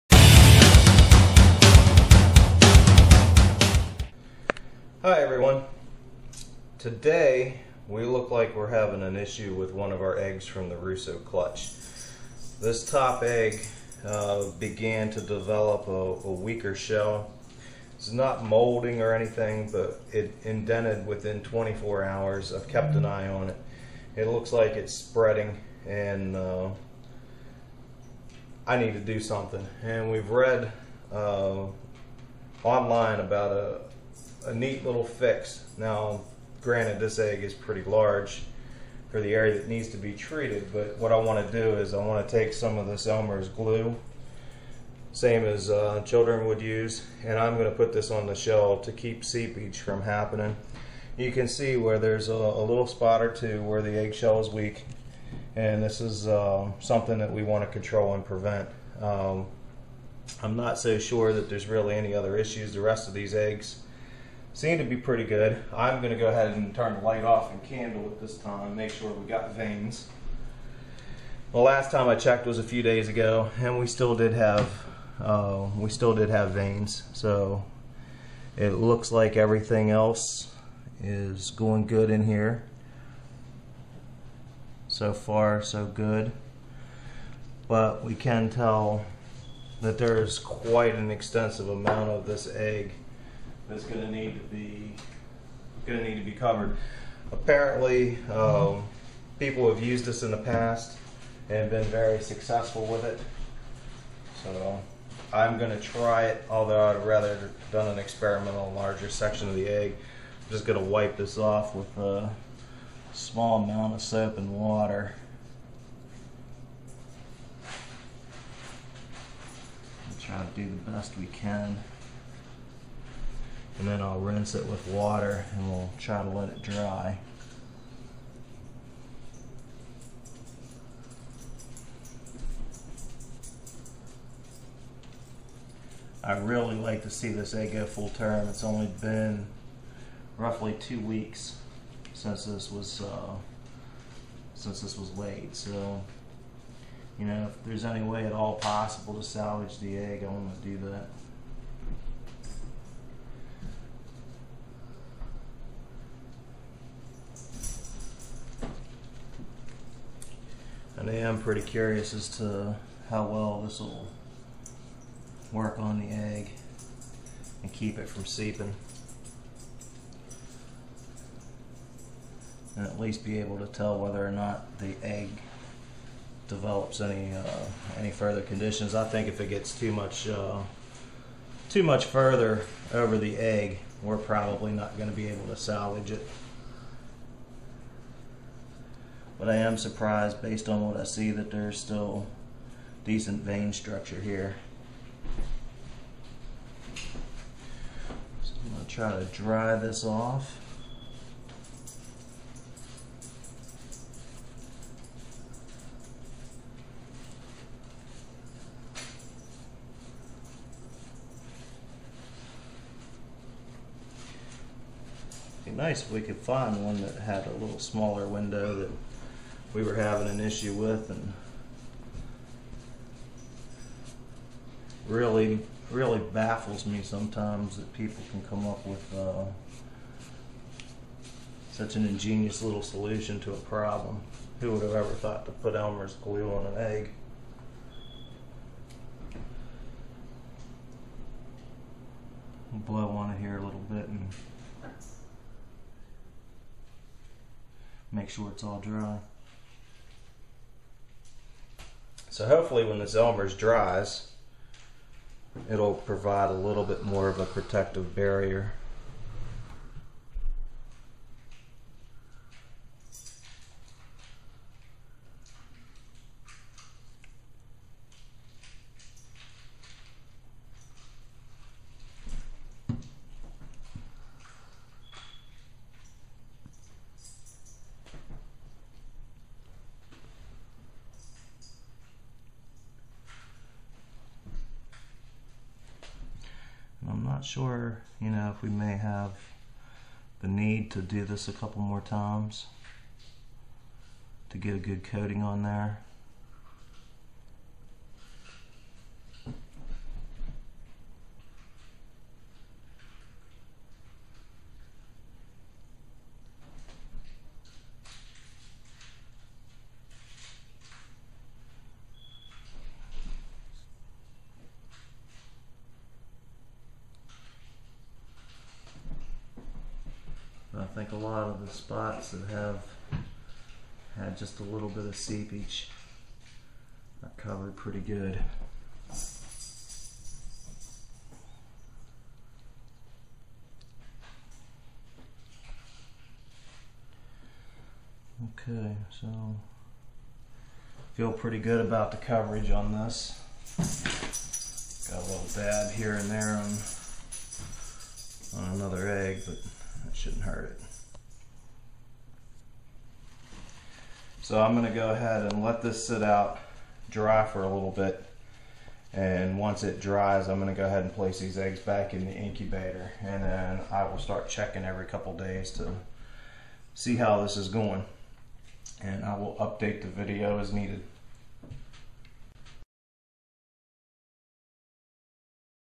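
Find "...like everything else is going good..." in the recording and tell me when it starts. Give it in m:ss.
1:19.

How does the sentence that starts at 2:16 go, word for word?
I really like to see this egg go full term.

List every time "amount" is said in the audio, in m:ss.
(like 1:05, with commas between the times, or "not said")
1:31, 1:53.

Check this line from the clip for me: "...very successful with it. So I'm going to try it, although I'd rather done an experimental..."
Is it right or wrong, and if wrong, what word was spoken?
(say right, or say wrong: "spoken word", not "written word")
right.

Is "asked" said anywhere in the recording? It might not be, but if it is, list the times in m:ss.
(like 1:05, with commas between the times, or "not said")
not said.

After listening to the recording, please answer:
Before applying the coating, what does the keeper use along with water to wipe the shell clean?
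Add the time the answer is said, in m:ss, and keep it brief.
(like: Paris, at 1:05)
soap, at 1:54.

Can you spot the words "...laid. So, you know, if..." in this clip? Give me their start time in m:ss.
2:25.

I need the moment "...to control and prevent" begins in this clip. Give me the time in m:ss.
0:57.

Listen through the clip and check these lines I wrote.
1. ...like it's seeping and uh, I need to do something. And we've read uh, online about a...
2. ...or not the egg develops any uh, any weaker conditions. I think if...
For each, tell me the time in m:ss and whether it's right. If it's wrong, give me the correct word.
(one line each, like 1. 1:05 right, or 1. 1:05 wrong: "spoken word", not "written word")
1. 0:24 wrong: "spreading", not "seeping"
2. 2:54 wrong: "further", not "weaker".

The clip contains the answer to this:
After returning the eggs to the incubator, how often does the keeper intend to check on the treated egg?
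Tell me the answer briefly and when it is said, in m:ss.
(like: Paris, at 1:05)
every couple days, at 6:04.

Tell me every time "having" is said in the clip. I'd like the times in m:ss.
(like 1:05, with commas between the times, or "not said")
0:08, 3:39.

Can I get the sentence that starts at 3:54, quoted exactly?
Who would have ever thought to put Elmer's glue on an egg?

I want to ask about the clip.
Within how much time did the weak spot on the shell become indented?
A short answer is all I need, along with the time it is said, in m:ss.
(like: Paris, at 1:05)
24 hours, at 0:21.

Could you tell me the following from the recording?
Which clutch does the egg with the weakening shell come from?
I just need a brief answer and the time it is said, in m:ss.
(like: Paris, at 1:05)
Russo, at 0:10.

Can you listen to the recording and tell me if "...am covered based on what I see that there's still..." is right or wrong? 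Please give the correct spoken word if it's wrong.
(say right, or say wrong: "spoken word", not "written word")
wrong: "surprised", not "covered".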